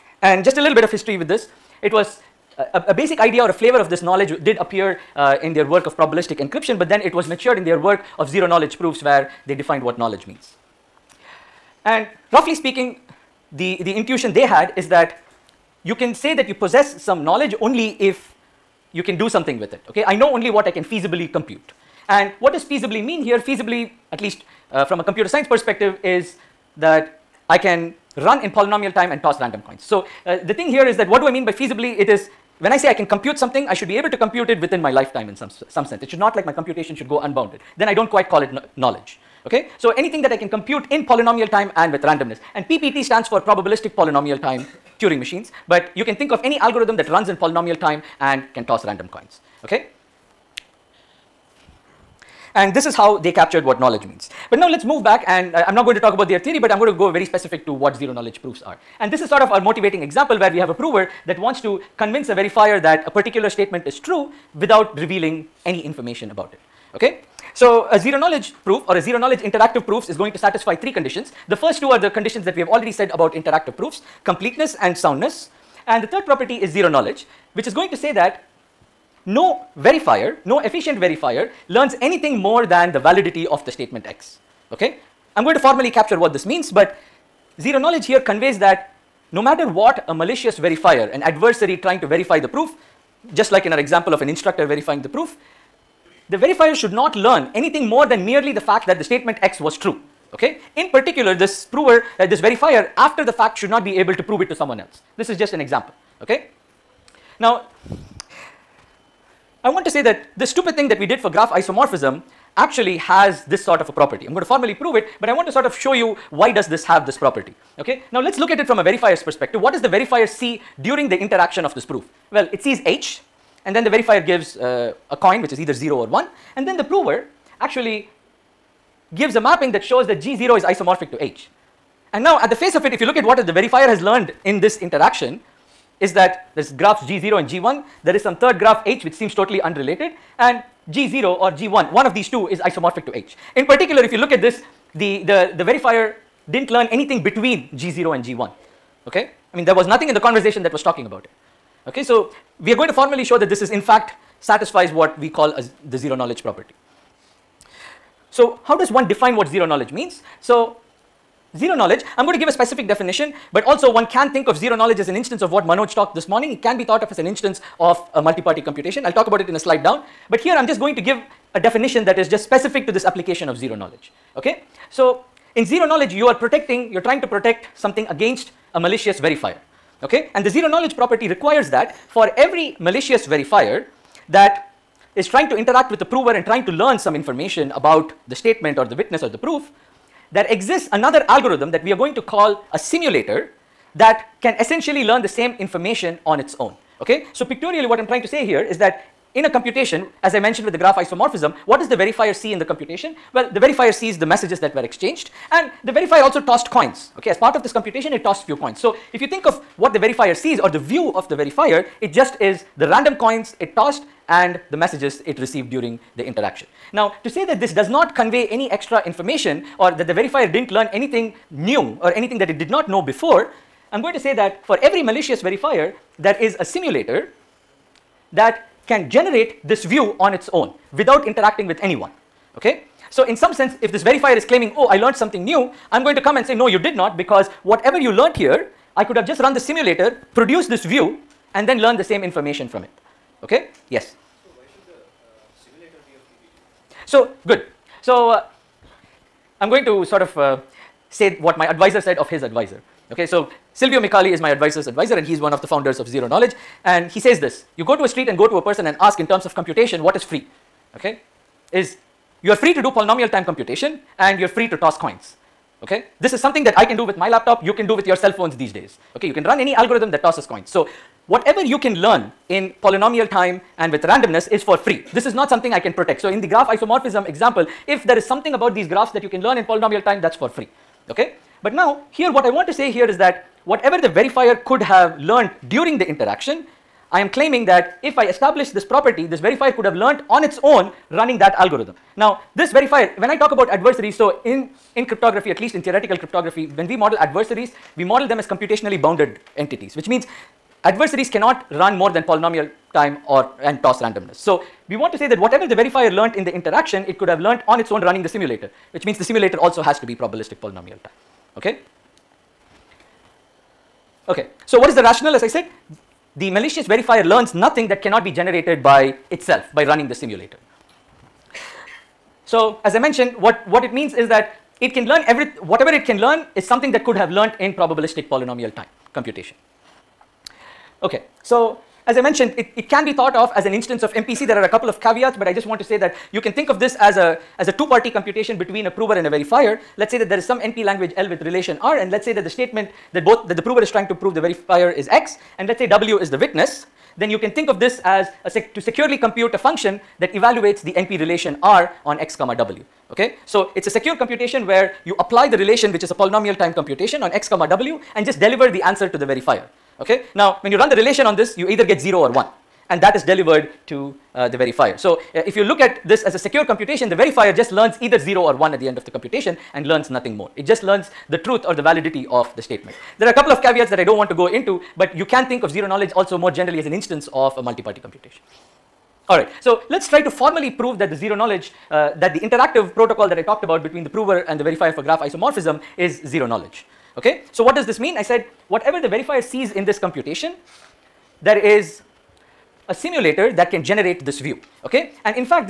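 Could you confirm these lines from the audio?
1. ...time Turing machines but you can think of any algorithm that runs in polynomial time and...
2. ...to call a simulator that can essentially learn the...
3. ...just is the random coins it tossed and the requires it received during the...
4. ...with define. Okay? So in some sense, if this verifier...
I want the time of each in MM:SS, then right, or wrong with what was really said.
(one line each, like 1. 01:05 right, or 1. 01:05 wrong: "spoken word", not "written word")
1. 00:44 right
2. 03:12 right
3. 03:32 wrong: "messages", not "requires"
4. 03:51 wrong: "anyone", not "define".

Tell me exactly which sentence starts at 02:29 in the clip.
I mean there was nothing in the conversation that was talking about it, okay.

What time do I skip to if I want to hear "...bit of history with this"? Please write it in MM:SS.
00:00.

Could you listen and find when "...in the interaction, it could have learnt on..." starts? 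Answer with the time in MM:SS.
05:06.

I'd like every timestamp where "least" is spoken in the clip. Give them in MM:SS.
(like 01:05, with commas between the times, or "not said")
00:24, 04:55.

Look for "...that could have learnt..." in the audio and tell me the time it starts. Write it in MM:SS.
05:26.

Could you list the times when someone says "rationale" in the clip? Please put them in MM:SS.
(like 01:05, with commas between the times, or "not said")
05:15.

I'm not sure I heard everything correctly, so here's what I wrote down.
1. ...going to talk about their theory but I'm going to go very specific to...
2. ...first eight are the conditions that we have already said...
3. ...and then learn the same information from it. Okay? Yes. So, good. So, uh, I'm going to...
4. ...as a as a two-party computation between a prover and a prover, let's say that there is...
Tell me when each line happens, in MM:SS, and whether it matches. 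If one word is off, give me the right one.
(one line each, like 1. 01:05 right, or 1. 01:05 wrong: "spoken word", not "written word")
1. 00:55 right
2. 01:11 wrong: "two", not "eight"
3. 04:01 right
4. 05:36 wrong: "verifier", not "prover".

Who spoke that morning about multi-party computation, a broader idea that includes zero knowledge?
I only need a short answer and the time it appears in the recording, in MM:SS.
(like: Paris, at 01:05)
Manoj, at 02:45.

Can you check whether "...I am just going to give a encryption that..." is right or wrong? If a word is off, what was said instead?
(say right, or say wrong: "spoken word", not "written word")
wrong: "definition", not "encryption".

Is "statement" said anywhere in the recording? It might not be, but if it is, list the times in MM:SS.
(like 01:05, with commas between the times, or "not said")
01:03, 01:23, 01:39, 03:08, 05:42, 06:12.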